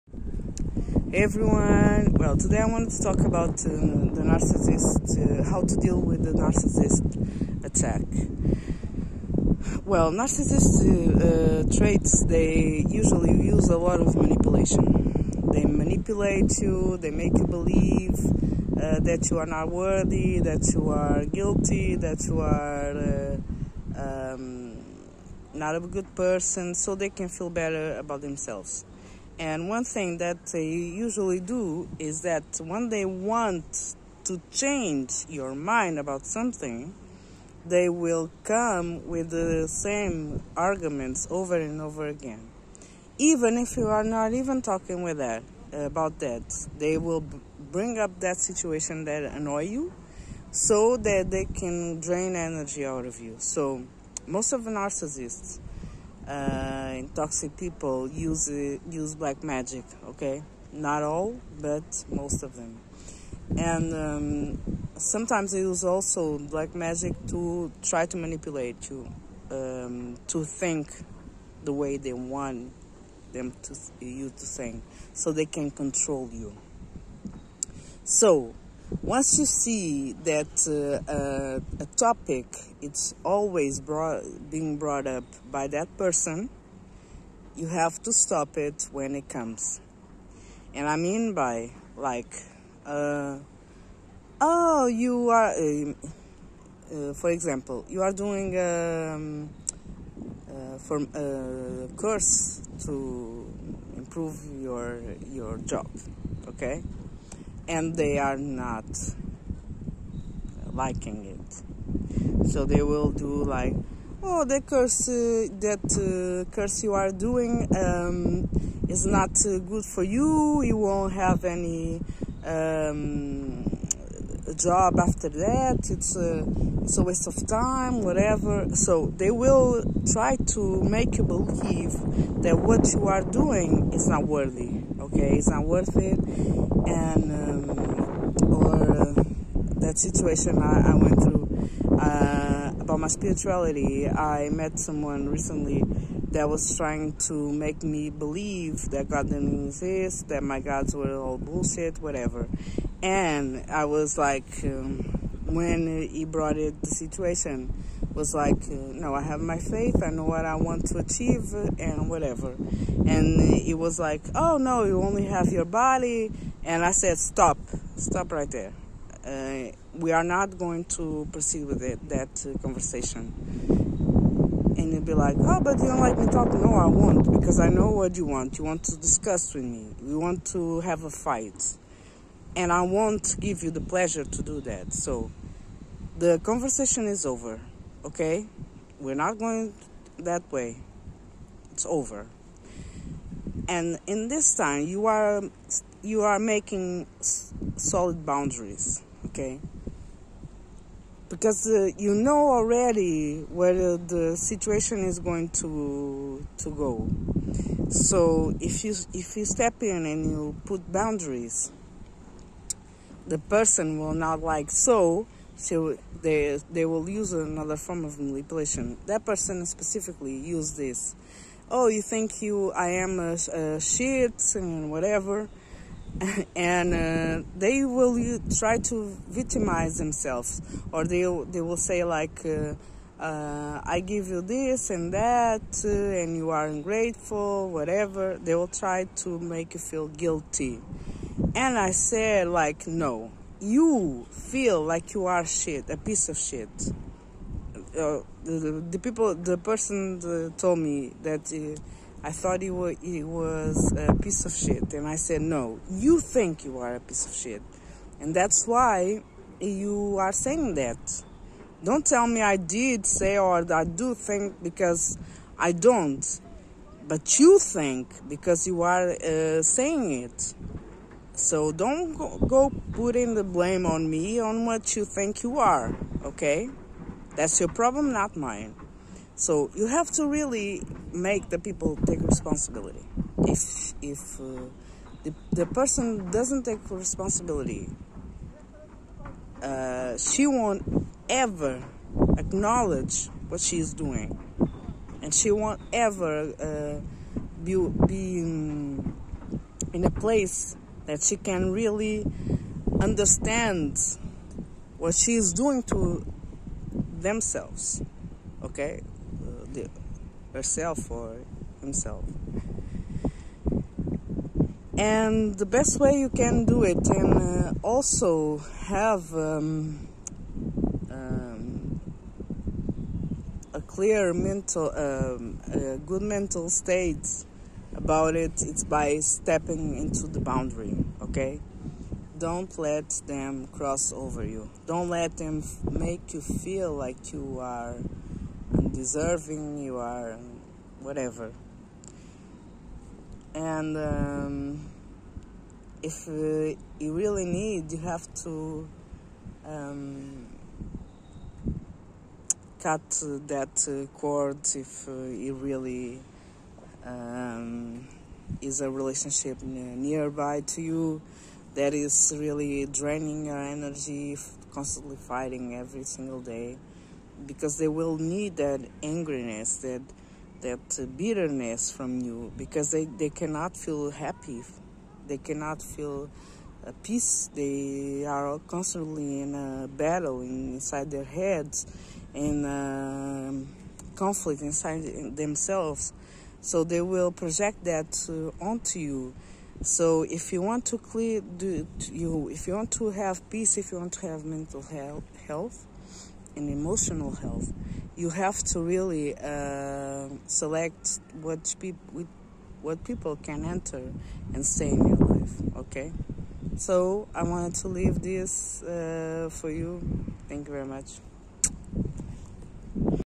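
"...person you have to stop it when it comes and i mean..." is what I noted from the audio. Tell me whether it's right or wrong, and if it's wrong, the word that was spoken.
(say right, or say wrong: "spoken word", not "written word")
right.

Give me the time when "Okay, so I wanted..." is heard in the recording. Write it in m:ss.
6:45.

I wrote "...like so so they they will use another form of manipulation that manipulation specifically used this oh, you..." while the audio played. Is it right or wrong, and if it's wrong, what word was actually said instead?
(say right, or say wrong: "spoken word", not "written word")
wrong: "person", not "manipulation".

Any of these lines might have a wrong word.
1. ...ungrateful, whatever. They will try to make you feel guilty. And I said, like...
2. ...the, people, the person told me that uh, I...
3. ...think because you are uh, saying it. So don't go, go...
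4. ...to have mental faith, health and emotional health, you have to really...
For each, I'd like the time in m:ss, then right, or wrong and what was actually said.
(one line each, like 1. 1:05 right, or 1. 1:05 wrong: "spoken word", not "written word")
1. 3:56 right
2. 4:08 right
3. 4:27 right
4. 6:34 wrong: "health", not "faith".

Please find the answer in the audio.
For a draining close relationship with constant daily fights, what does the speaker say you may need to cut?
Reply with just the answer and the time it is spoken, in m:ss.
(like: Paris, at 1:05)
cord, at 5:54.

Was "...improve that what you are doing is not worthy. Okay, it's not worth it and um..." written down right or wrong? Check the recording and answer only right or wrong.
wrong.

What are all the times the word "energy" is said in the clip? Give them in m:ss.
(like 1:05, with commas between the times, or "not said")
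0:52, 6:03.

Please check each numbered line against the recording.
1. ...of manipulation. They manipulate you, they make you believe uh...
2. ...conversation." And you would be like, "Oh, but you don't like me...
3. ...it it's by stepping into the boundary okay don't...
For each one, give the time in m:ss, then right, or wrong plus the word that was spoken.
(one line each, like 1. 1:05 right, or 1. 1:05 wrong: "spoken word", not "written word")
1. 0:13 right
2. 2:52 right
3. 5:28 right.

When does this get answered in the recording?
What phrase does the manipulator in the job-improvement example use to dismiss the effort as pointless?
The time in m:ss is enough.
2:07.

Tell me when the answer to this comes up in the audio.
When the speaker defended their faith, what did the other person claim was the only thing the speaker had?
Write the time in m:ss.
2:45.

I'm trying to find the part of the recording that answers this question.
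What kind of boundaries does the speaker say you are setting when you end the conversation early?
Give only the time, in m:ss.
3:17.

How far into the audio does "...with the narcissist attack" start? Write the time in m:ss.
0:05.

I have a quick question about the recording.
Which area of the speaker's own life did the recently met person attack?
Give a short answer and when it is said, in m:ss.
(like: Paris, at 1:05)
spirituality, at 2:23.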